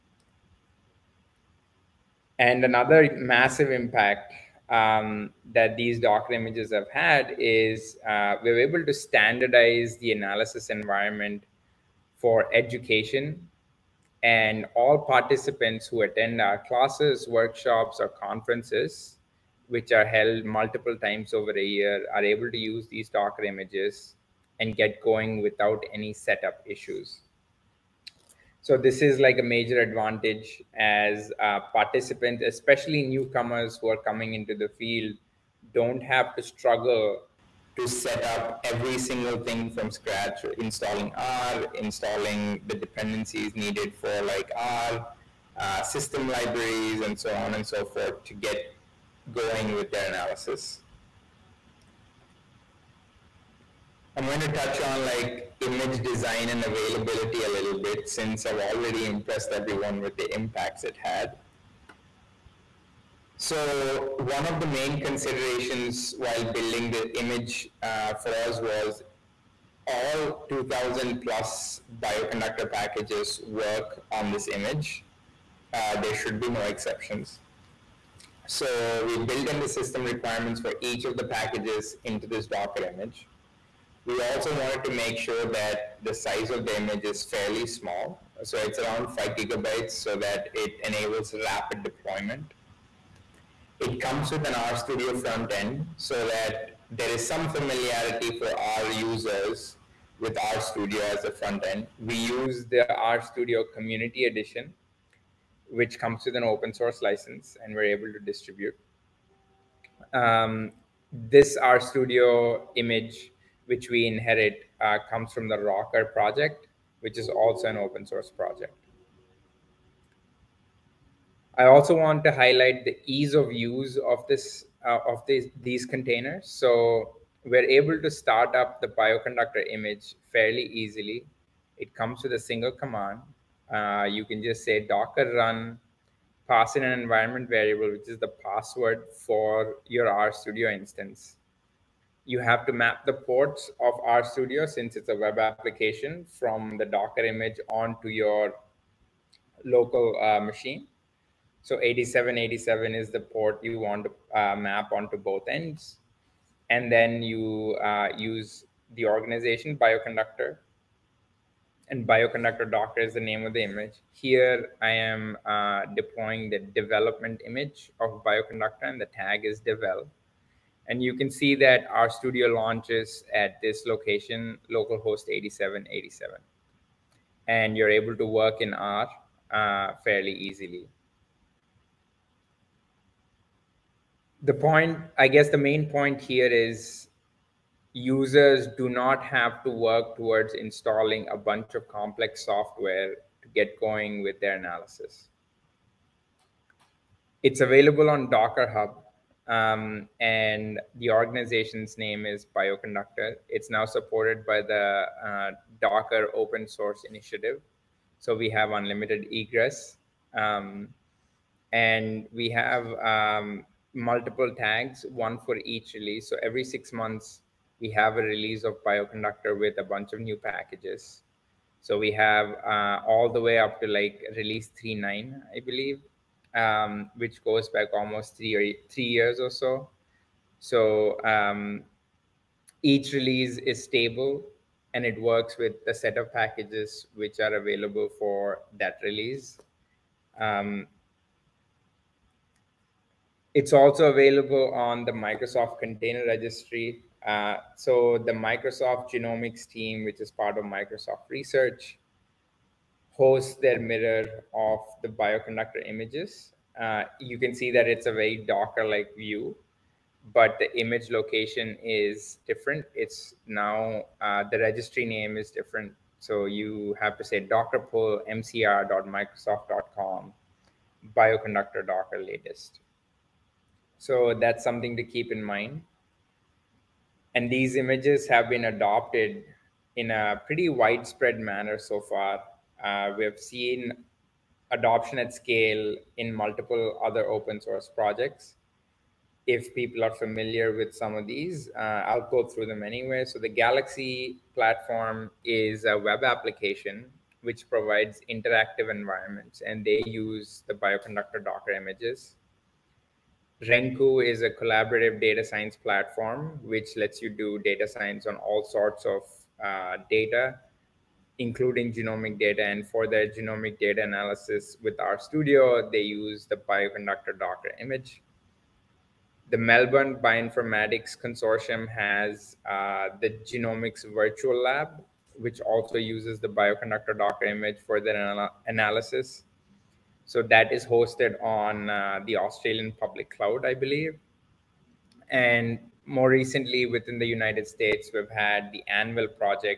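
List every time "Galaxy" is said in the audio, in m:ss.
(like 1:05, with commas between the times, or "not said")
4:53.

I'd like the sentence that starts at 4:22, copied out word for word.
It's now, uh, the registry name is different.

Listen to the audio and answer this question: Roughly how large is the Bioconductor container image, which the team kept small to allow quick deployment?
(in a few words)
5 gigabytes.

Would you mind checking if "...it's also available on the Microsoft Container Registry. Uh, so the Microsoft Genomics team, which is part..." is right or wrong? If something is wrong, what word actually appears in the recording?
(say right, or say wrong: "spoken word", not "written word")
right.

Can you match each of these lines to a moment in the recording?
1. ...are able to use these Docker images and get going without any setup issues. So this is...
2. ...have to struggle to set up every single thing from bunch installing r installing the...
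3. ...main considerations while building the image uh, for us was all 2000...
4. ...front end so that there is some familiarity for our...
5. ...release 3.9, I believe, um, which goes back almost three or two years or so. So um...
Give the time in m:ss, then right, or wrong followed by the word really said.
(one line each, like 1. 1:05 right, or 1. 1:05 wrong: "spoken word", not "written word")
1. 0:22 right
2. 0:36 wrong: "scratch", not "bunch"
3. 1:04 right
4. 1:35 right
5. 3:44 wrong: "three", not "two".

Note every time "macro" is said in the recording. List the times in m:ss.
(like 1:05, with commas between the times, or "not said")
not said.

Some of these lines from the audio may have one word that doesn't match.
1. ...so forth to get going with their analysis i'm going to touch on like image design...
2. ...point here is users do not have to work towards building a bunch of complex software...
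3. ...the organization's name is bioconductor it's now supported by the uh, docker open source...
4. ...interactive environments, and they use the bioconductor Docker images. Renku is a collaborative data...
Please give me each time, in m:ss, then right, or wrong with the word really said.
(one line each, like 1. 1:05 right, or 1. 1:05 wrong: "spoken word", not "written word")
1. 0:47 right
2. 3:05 wrong: "installing", not "building"
3. 3:20 right
4. 4:58 right.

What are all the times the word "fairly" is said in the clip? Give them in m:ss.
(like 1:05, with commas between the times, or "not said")
1:27, 2:10, 3:00.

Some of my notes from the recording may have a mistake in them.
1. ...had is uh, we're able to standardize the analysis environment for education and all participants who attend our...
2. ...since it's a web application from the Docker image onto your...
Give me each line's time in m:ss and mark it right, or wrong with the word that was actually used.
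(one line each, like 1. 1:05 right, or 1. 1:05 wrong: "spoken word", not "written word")
1. 0:06 right
2. 2:24 right.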